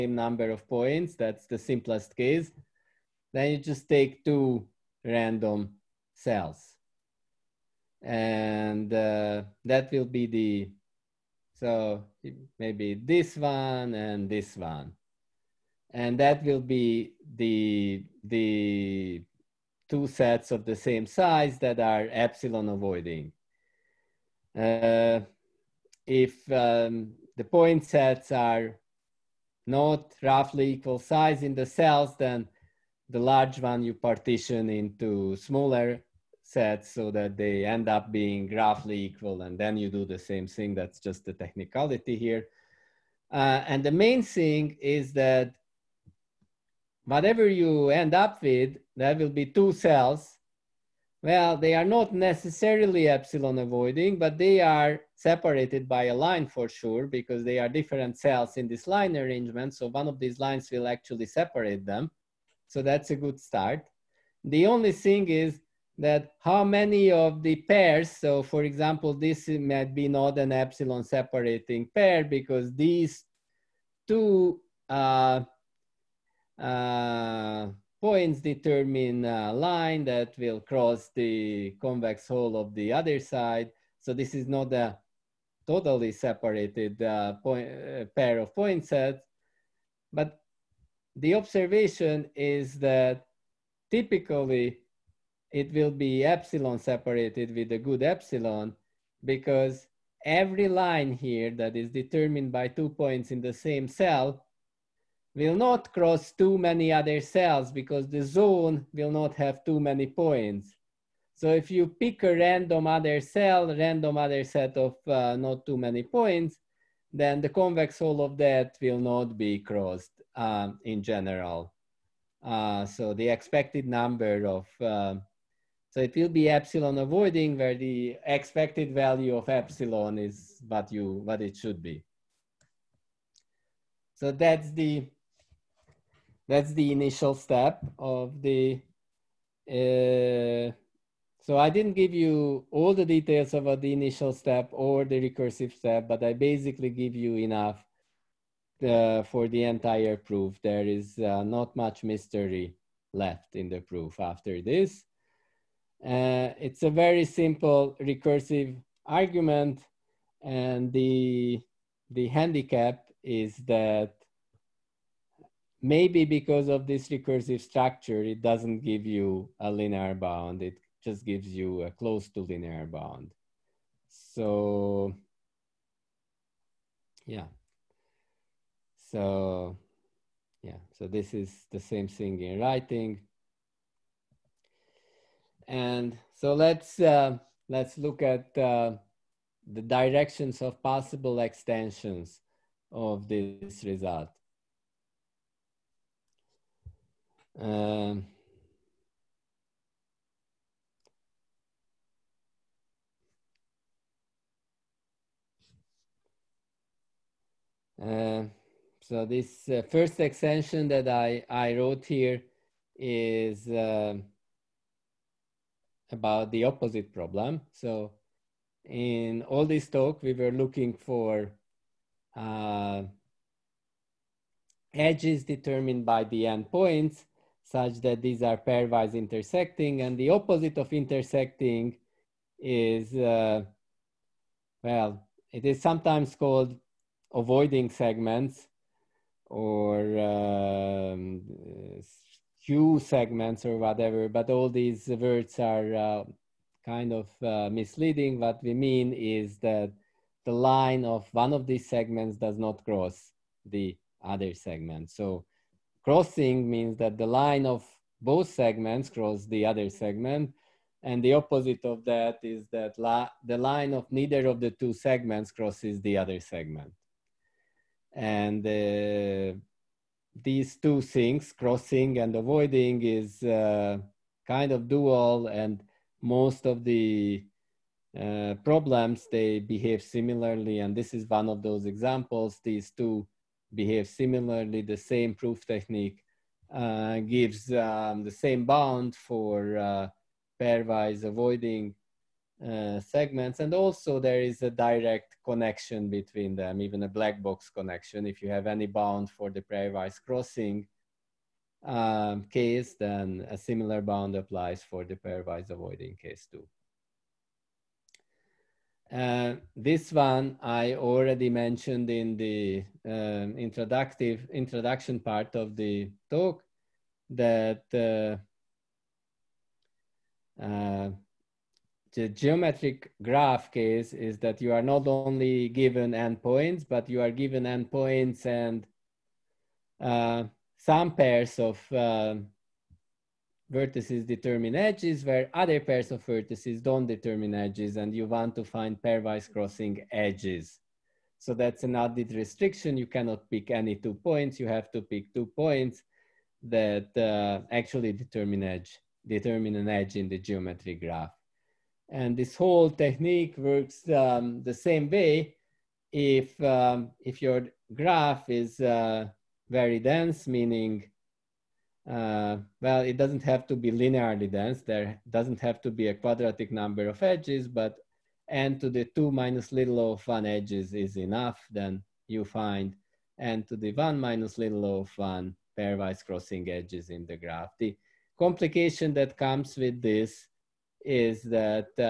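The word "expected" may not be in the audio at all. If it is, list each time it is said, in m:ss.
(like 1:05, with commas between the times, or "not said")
2:03, 2:08.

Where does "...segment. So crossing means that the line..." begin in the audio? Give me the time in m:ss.
4:14.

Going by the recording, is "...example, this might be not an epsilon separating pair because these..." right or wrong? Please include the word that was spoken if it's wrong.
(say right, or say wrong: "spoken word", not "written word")
right.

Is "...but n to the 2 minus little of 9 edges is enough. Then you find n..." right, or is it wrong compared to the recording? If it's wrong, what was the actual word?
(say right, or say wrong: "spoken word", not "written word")
wrong: "1", not "9".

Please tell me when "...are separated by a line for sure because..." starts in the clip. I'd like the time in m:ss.
0:54.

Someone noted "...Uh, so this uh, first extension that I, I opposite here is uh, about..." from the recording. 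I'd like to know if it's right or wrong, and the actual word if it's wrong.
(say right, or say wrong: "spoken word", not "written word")
wrong: "wrote", not "opposite".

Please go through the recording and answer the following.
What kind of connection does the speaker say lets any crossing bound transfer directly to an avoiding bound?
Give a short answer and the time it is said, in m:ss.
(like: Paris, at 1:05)
black box connection, at 4:57.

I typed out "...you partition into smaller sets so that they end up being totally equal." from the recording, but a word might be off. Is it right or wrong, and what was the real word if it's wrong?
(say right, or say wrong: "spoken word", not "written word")
wrong: "roughly", not "totally".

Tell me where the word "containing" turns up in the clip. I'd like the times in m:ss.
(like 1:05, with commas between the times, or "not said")
not said.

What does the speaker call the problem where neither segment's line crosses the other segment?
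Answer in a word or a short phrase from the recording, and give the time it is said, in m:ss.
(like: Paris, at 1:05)
avoiding segments, at 3:57.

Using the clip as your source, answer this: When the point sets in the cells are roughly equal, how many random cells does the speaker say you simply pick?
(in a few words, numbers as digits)
2.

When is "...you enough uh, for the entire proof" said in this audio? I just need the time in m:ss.
2:27.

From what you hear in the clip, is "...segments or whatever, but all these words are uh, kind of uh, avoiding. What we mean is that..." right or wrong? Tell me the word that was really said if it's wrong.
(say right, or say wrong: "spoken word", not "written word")
wrong: "misleading", not "avoiding".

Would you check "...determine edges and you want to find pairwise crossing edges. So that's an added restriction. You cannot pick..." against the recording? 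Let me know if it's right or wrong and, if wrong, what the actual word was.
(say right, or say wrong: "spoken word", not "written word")
right.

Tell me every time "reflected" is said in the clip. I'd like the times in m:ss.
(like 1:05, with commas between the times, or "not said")
not said.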